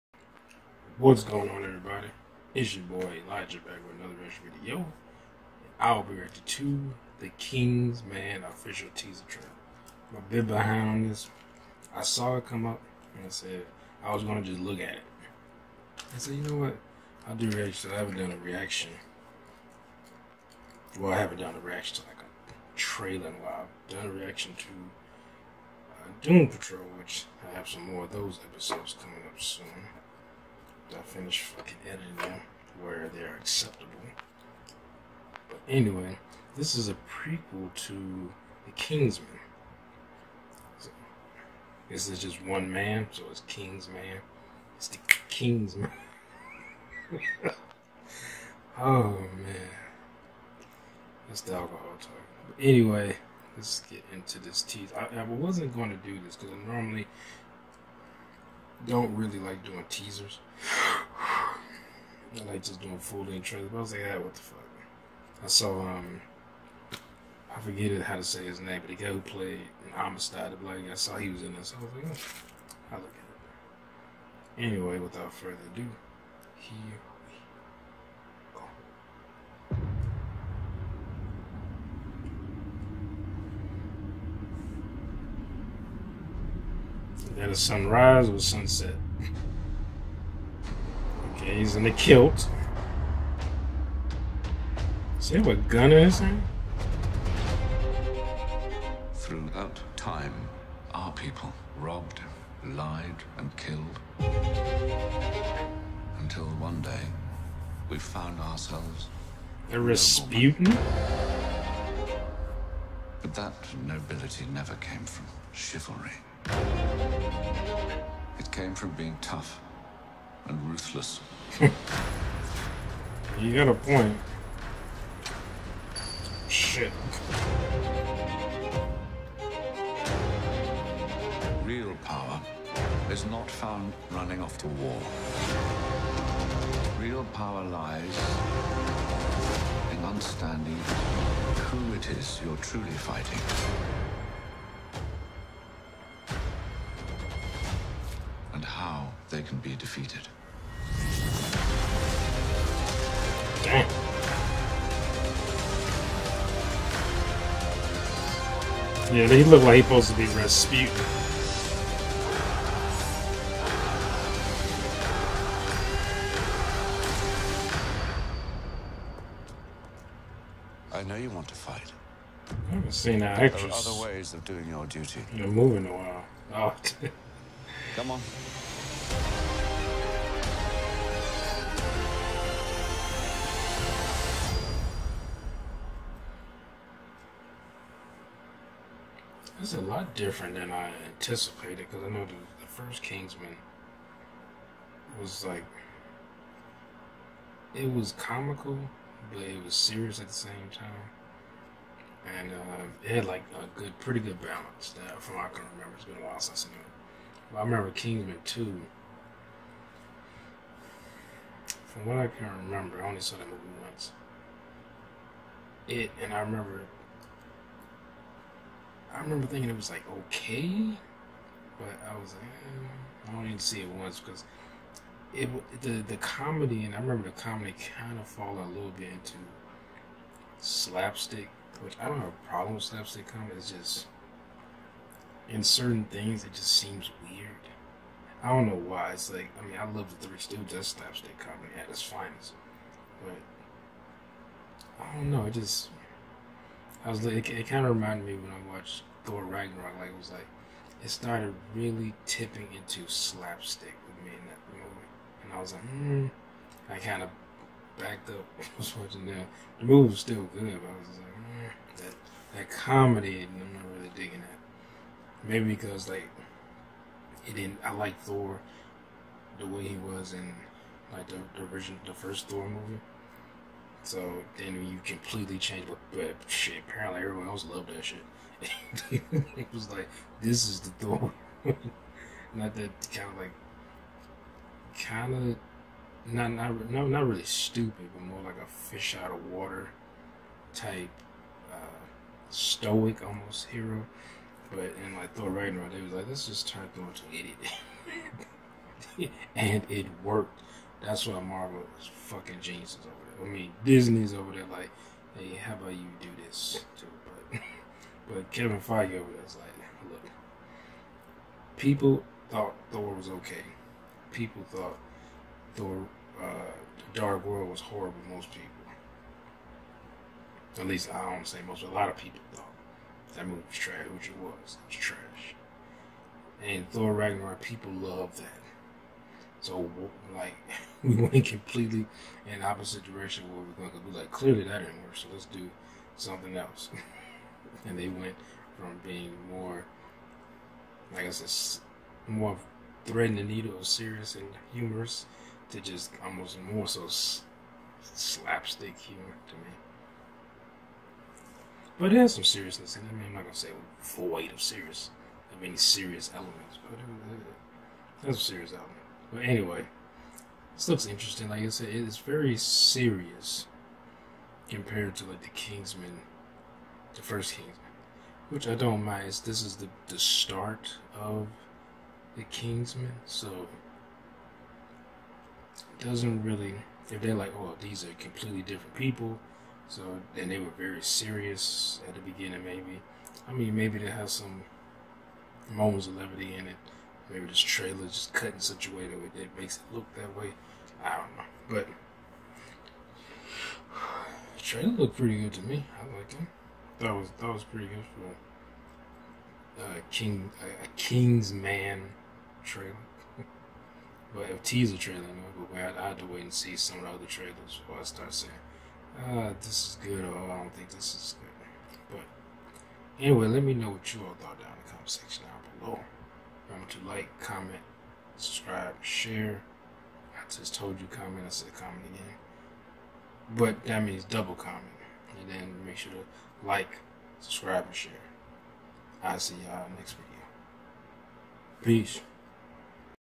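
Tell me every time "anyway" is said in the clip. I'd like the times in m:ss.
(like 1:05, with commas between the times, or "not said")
0:35, 0:52, 1:14, 5:59, 6:53.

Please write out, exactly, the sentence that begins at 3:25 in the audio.
That from I can remember, it's been a while since I've seen it.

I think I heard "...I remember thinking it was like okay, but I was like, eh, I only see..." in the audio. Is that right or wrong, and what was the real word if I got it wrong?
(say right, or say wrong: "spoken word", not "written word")
right.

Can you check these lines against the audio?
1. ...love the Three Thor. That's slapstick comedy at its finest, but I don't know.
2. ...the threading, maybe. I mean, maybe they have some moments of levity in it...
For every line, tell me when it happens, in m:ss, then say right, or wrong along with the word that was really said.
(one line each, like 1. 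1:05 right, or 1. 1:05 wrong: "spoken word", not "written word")
1. 3:59 wrong: "Stooges", not "Thor"
2. 6:22 wrong: "beginning", not "threading".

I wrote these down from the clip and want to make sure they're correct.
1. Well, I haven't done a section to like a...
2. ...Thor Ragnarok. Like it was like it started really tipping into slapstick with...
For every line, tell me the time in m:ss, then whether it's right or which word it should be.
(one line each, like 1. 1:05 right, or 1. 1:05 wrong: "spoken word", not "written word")
1. 0:20 wrong: "reaction", not "section"
2. 4:09 right.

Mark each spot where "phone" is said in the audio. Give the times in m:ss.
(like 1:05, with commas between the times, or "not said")
not said.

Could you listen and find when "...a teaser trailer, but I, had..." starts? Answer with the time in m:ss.
6:44.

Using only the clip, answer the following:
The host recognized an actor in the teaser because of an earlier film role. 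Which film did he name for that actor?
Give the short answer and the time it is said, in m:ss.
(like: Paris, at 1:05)
Amistad, at 1:09.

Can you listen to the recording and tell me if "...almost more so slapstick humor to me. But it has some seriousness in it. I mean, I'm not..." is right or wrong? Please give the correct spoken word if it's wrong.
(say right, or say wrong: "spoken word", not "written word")
right.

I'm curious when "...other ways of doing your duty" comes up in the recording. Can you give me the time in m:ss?
2:54.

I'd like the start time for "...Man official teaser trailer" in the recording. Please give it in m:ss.
0:08.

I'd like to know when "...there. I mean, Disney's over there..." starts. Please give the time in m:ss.
5:03.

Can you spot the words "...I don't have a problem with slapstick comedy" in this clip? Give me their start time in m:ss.
3:52.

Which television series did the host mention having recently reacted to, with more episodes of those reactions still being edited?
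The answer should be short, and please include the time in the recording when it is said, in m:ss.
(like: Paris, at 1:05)
Doom Patrol, at 0:26.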